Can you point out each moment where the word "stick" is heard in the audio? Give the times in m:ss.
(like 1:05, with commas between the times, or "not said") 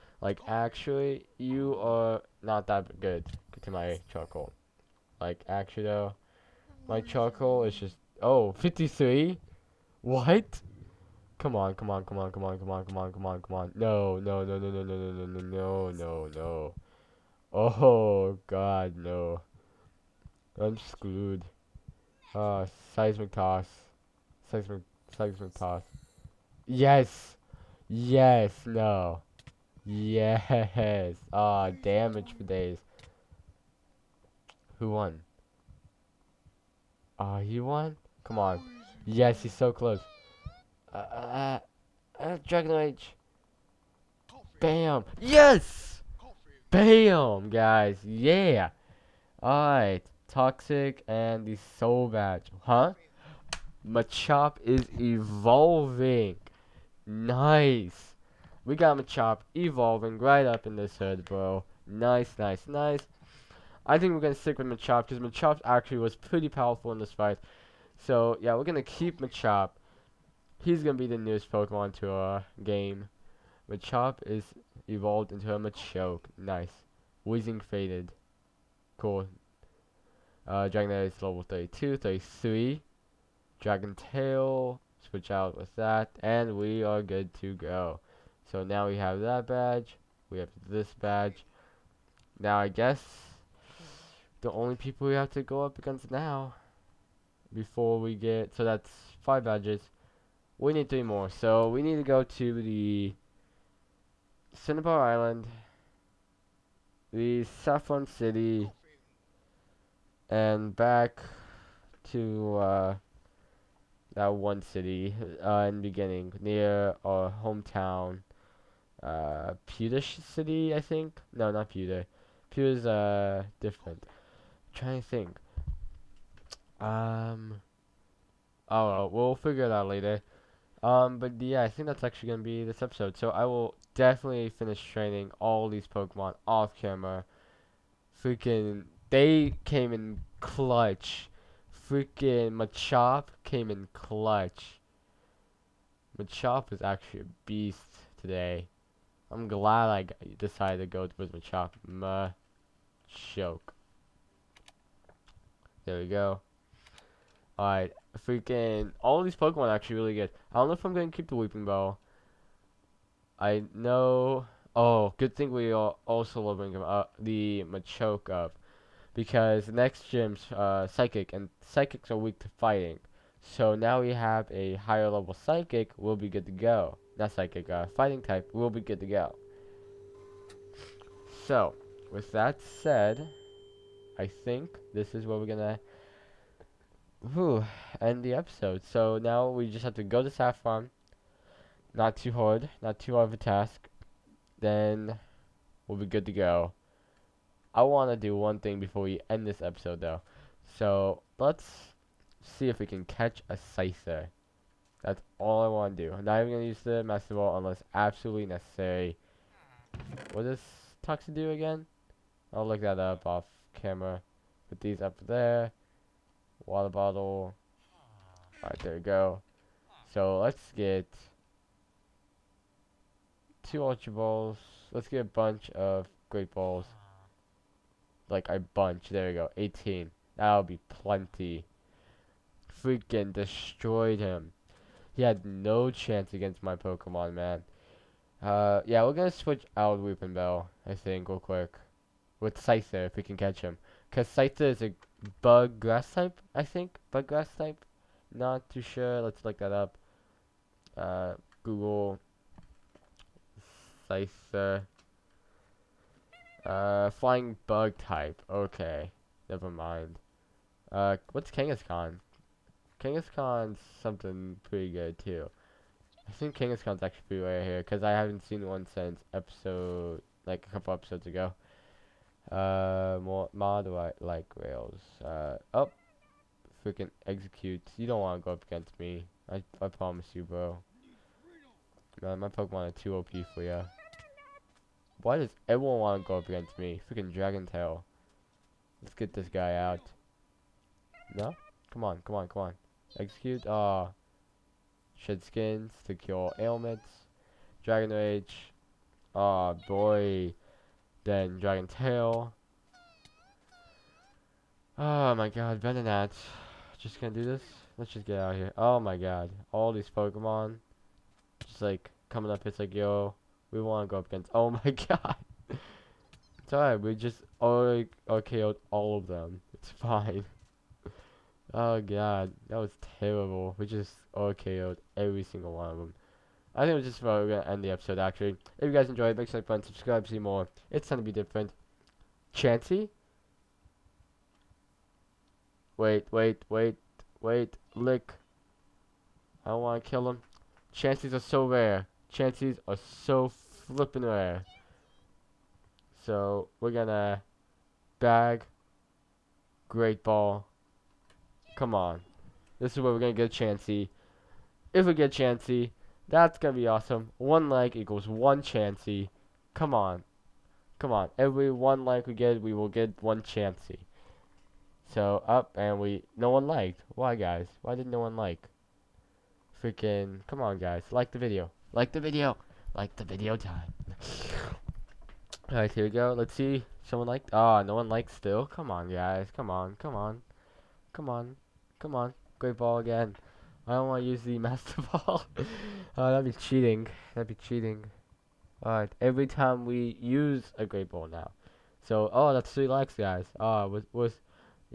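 1:04.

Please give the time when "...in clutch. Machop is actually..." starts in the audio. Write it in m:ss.
2:23.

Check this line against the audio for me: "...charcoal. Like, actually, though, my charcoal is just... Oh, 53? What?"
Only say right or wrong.
right.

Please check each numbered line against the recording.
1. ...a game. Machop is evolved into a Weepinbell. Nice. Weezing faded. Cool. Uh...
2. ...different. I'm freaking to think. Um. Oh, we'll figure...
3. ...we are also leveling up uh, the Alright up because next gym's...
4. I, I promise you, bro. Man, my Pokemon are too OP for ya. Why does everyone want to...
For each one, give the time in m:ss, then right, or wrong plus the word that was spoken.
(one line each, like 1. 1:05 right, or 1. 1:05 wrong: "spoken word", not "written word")
1. 1:12 wrong: "Machoke", not "Weepinbell"
2. 2:03 wrong: "trying", not "freaking"
3. 2:45 wrong: "Machoke", not "Alright"
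4. 4:39 right.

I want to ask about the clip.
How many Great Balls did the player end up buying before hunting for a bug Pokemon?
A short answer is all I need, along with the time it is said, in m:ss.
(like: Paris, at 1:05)
18, at 3:49.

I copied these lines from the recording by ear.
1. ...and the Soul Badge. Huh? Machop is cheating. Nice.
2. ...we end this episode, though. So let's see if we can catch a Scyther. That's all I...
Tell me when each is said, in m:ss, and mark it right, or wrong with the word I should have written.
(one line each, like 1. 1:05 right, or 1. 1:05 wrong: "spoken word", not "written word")
1. 0:51 wrong: "evolving", not "cheating"
2. 3:19 right.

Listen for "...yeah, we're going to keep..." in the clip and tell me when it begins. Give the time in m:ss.
1:08.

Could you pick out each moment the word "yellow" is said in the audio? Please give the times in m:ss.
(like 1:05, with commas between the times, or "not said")
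not said.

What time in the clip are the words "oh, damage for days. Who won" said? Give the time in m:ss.
0:31.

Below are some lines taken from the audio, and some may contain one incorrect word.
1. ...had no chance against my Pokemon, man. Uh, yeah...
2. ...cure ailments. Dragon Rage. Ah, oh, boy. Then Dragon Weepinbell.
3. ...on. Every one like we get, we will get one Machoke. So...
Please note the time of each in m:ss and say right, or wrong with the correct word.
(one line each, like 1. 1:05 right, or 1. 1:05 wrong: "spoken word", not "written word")
1. 3:55 right
2. 4:56 wrong: "Tail", not "Weepinbell"
3. 6:01 wrong: "Chansey", not "Machoke".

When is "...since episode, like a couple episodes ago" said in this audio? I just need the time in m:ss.
4:28.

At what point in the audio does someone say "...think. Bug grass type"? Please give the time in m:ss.
4:06.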